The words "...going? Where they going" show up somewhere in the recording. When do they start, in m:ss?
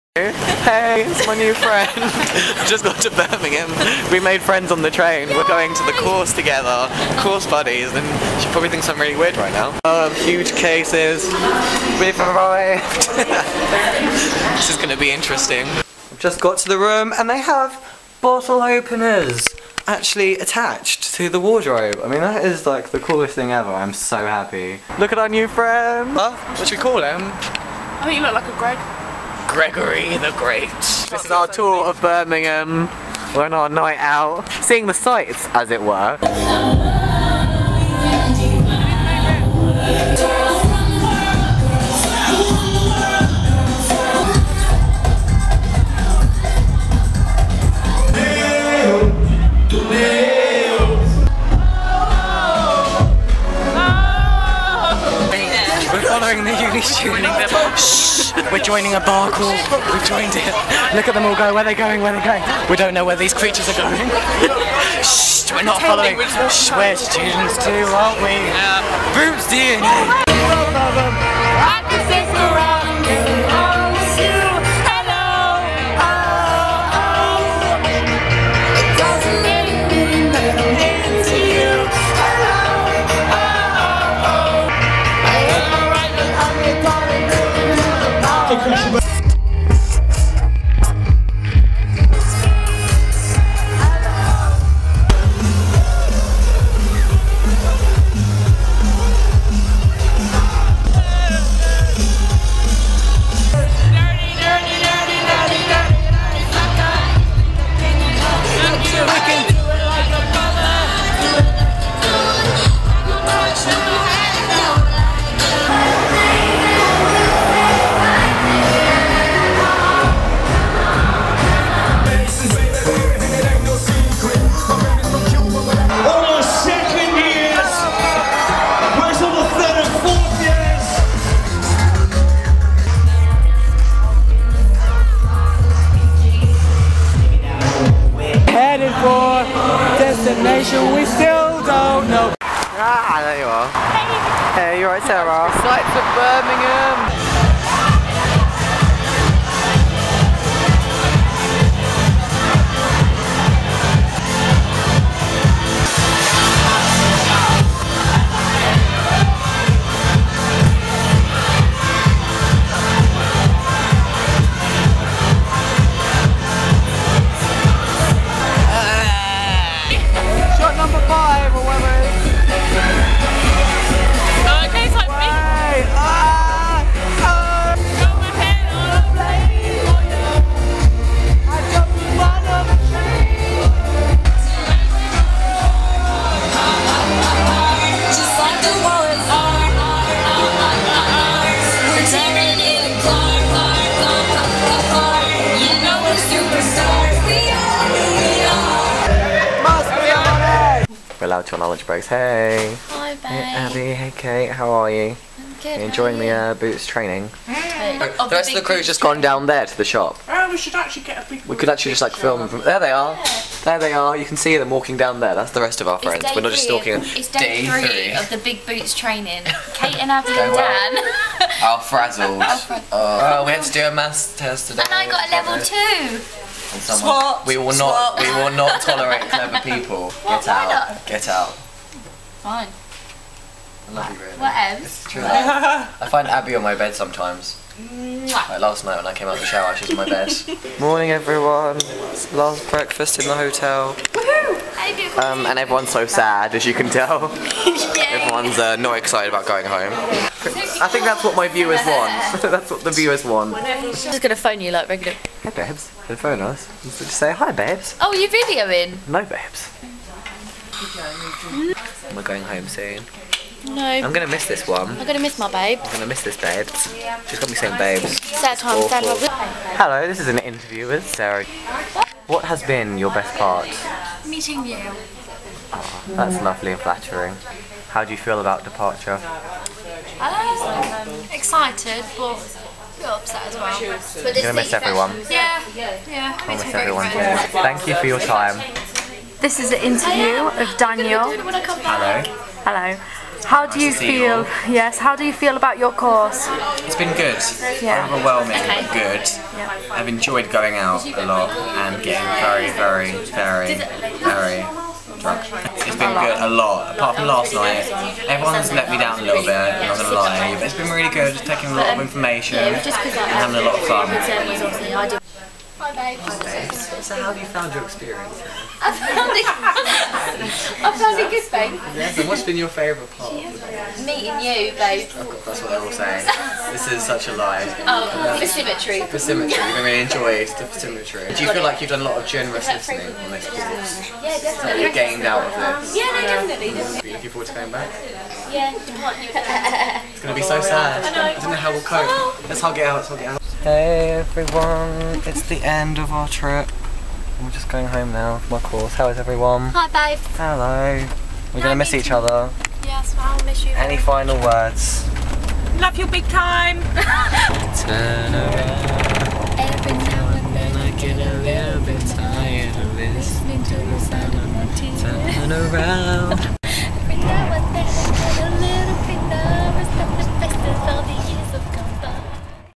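1:01.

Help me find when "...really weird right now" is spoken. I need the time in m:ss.
0:08.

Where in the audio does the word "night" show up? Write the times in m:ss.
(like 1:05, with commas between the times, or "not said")
0:33, 3:58, 5:07.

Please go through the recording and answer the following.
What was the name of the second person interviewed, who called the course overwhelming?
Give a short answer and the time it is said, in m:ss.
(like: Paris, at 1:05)
Daniel, at 4:49.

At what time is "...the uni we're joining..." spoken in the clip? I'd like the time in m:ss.
0:56.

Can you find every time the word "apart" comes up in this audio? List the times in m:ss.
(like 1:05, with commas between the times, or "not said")
5:06.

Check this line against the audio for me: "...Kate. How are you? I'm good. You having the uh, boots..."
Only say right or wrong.
wrong.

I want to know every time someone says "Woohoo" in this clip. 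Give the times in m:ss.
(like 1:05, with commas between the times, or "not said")
4:03.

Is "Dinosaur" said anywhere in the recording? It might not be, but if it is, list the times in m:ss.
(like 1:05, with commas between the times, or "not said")
not said.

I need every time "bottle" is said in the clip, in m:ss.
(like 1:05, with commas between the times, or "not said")
0:18.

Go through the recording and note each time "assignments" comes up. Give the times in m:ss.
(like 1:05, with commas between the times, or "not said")
not said.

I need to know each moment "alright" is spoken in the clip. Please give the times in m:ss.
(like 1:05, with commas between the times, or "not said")
2:24.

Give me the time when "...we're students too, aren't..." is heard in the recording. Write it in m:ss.
1:06.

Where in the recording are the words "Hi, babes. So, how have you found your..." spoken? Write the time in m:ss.
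5:15.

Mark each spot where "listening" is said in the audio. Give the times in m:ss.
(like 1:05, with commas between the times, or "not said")
5:32, 6:02.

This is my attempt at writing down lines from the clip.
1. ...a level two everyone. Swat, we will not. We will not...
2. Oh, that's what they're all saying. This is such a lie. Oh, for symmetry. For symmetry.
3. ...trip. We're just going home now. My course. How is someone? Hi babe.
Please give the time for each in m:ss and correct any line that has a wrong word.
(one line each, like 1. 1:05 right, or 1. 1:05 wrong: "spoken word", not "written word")
1. 3:45 wrong: "someone", not "everyone"
2. 5:25 right
3. 5:46 wrong: "everyone", not "someone".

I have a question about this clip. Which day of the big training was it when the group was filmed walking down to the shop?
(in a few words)
Day 3.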